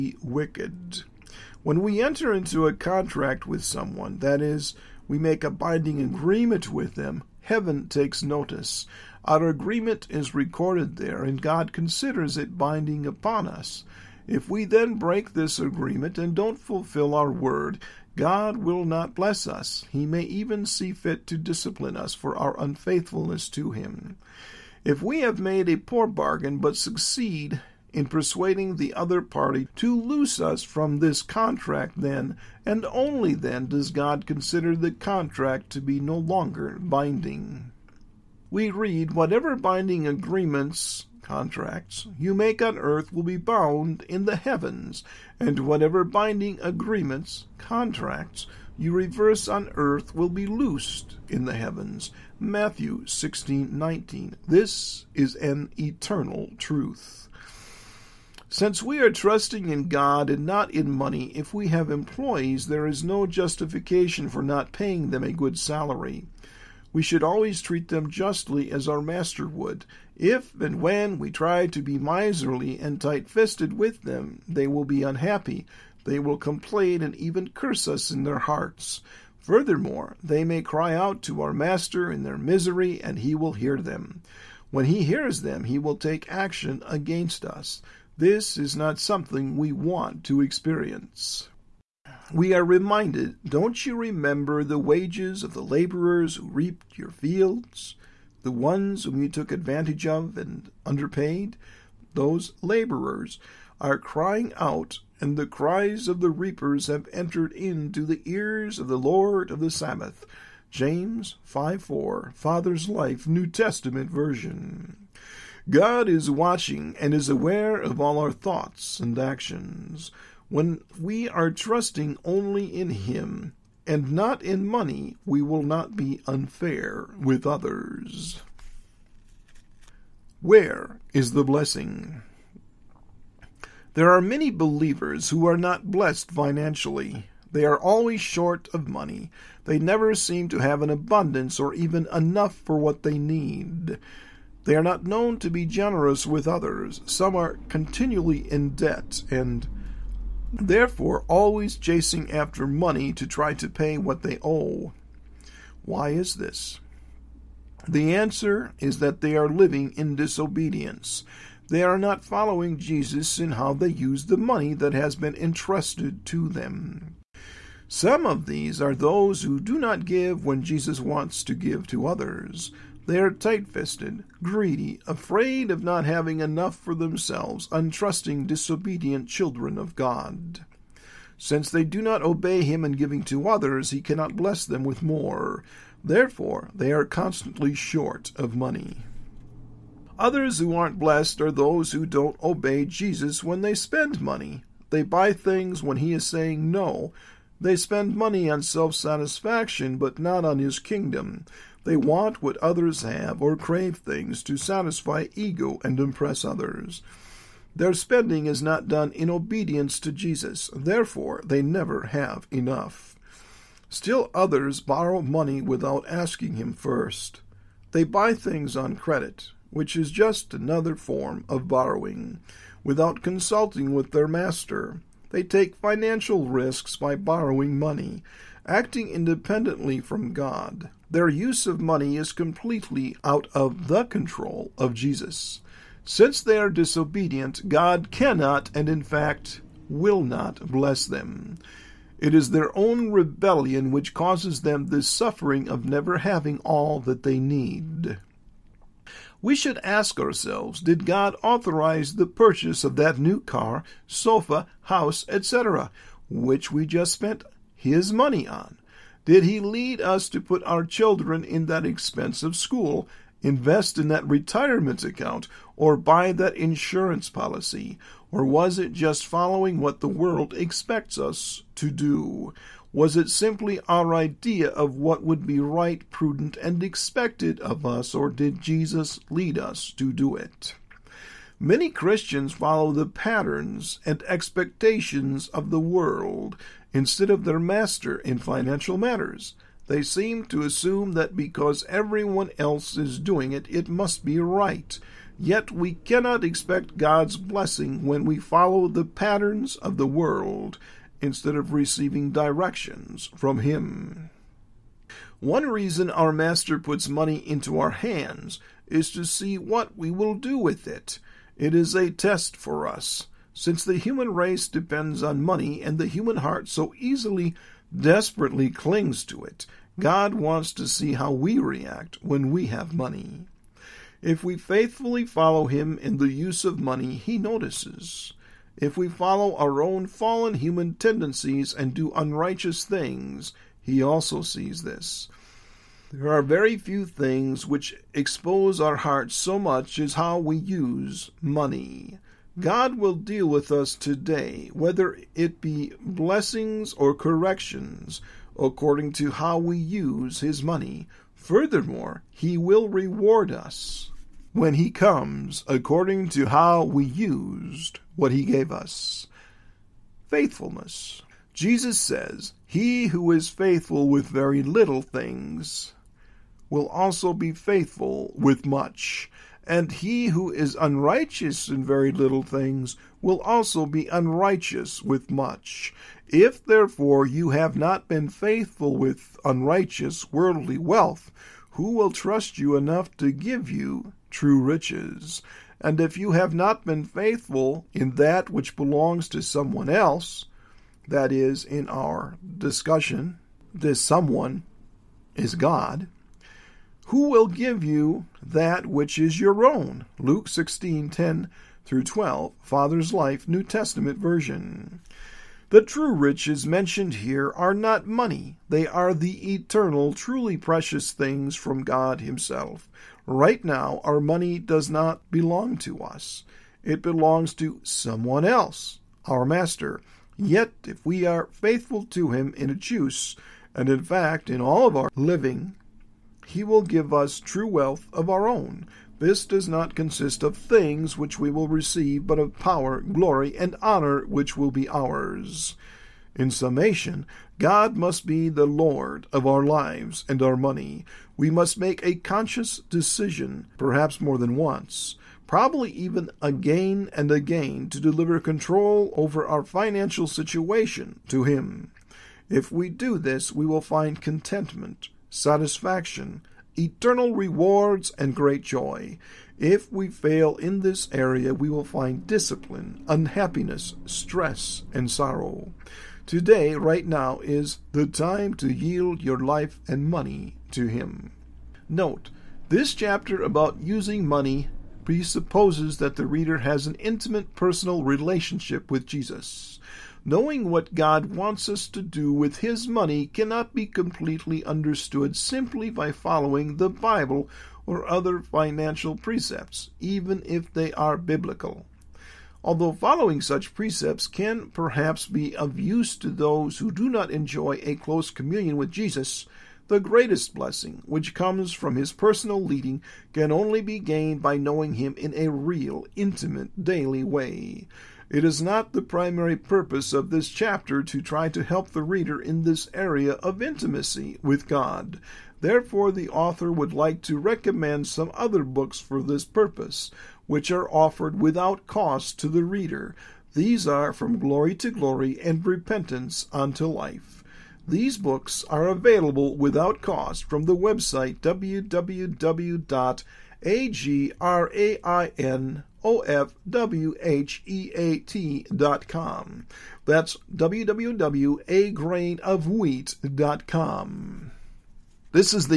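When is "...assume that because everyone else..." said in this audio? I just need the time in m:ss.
4:50.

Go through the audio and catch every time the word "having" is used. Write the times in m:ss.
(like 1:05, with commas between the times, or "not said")
2:56, 4:06.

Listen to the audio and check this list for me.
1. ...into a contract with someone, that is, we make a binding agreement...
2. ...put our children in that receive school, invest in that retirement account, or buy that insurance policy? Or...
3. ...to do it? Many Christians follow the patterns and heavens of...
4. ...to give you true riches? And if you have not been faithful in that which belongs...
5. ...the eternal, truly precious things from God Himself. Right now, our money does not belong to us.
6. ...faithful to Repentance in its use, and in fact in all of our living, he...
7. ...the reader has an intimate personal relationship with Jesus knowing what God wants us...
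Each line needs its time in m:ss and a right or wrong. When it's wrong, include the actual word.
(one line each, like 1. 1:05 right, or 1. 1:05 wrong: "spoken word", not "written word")
1. 0:02 right
2. 4:20 wrong: "expensive", not "receive"
3. 4:39 wrong: "expectations", not "heavens"
4. 6:23 right
5. 6:49 right
6. 7:01 wrong: "Him", not "Repentance"
7. 7:56 right.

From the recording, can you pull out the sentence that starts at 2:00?
When we are trusting only in Him, and not in money, we will not be unfair with others.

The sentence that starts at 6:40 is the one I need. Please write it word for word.
Luke 16:10 through 12, Father's Life, New Testament version.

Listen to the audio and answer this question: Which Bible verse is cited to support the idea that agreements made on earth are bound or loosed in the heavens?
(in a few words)
Matthew 16:19.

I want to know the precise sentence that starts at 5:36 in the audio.
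There are very few things which expose our hearts so much as how we use money.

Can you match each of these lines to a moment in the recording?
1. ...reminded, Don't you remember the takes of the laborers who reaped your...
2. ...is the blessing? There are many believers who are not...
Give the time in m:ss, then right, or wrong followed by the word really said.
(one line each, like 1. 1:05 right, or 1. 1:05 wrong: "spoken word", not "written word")
1. 1:32 wrong: "wages", not "takes"
2. 2:11 right.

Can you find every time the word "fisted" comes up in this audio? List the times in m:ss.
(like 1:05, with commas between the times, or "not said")
1:13, 2:53.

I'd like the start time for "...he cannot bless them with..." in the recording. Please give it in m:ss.
3:03.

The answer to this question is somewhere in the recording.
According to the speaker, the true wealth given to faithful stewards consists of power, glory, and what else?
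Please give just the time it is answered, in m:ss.
7:13.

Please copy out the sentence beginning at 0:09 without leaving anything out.
Our agreement is recorded there, and God considers it binding upon us.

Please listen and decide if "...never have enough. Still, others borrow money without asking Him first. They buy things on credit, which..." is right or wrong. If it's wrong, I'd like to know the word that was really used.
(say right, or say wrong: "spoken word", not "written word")
right.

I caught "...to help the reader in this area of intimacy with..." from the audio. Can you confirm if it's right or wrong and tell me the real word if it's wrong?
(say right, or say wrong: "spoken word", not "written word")
right.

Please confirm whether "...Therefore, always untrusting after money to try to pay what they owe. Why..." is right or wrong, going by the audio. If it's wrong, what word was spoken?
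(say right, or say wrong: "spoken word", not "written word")
wrong: "chasing", not "untrusting".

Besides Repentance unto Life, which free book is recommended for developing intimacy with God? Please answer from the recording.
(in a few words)
From Glory to Glory.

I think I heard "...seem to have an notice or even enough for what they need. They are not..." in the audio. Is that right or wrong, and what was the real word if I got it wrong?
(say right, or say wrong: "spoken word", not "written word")
wrong: "abundance", not "notice".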